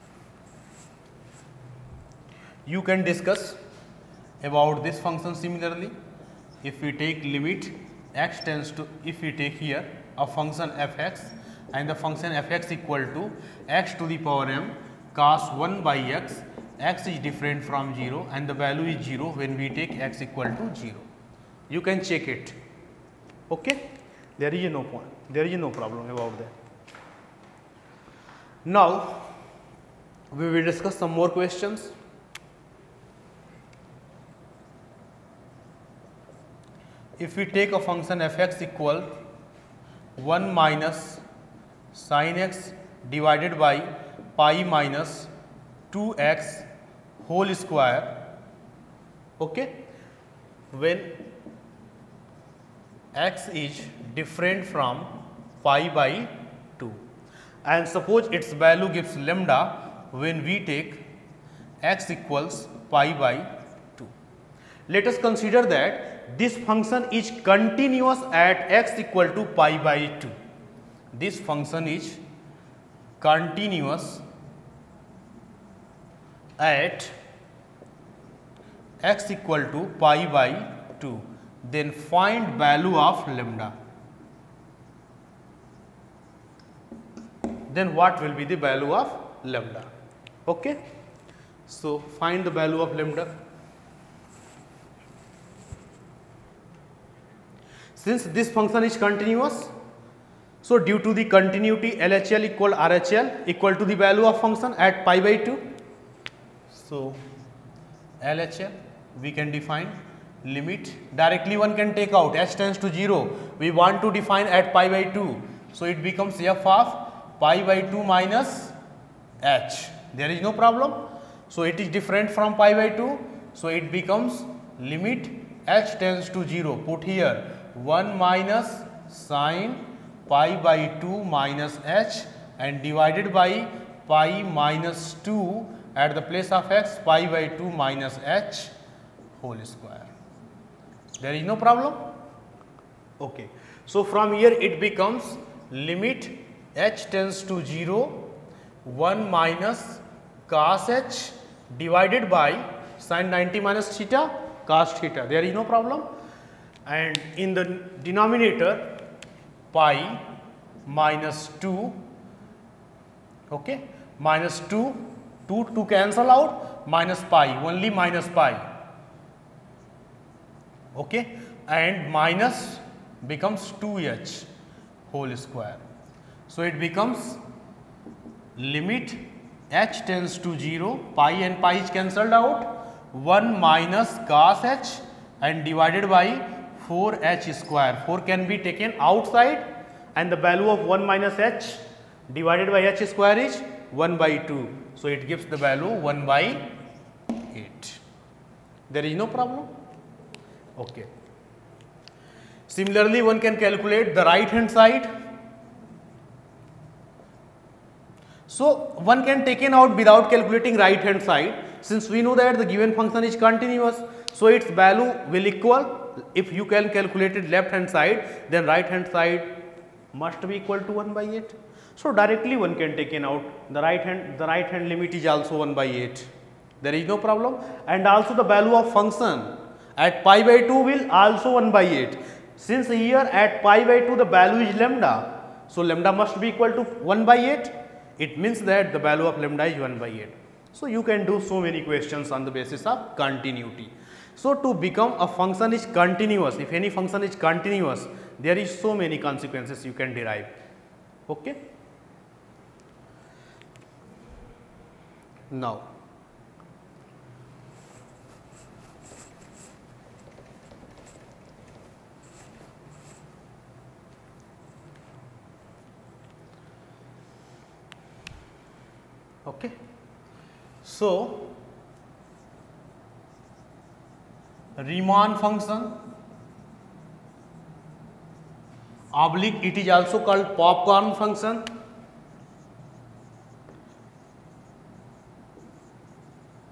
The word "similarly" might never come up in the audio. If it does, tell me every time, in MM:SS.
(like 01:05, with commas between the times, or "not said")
00:05, 03:22.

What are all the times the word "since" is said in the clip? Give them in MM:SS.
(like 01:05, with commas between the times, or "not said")
01:38, 03:31, 03:52.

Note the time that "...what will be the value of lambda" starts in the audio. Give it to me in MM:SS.
01:27.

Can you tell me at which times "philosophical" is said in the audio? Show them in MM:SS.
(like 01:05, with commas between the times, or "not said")
not said.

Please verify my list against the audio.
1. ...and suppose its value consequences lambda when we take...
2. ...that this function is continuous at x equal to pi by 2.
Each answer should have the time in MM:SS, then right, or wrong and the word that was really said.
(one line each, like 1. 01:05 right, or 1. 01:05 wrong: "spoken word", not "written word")
1. 00:57 wrong: "gives", not "consequences"
2. 01:05 right.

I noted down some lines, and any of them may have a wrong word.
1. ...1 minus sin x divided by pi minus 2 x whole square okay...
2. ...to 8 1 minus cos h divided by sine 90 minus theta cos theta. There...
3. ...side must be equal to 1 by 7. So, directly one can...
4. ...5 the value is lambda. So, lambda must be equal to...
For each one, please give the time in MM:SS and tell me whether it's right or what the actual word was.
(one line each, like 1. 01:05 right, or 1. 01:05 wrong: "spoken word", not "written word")
1. 00:40 right
2. 02:27 wrong: "0", not "8"
3. 03:39 wrong: "8", not "7"
4. 03:54 wrong: "2", not "5".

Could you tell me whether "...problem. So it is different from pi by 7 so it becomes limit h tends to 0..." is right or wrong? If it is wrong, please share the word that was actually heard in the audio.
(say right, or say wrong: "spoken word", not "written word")
wrong: "2", not "7".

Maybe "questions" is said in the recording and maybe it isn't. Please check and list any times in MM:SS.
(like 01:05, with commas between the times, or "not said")
00:31, 04:01.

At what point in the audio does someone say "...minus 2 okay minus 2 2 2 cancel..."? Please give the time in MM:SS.
02:40.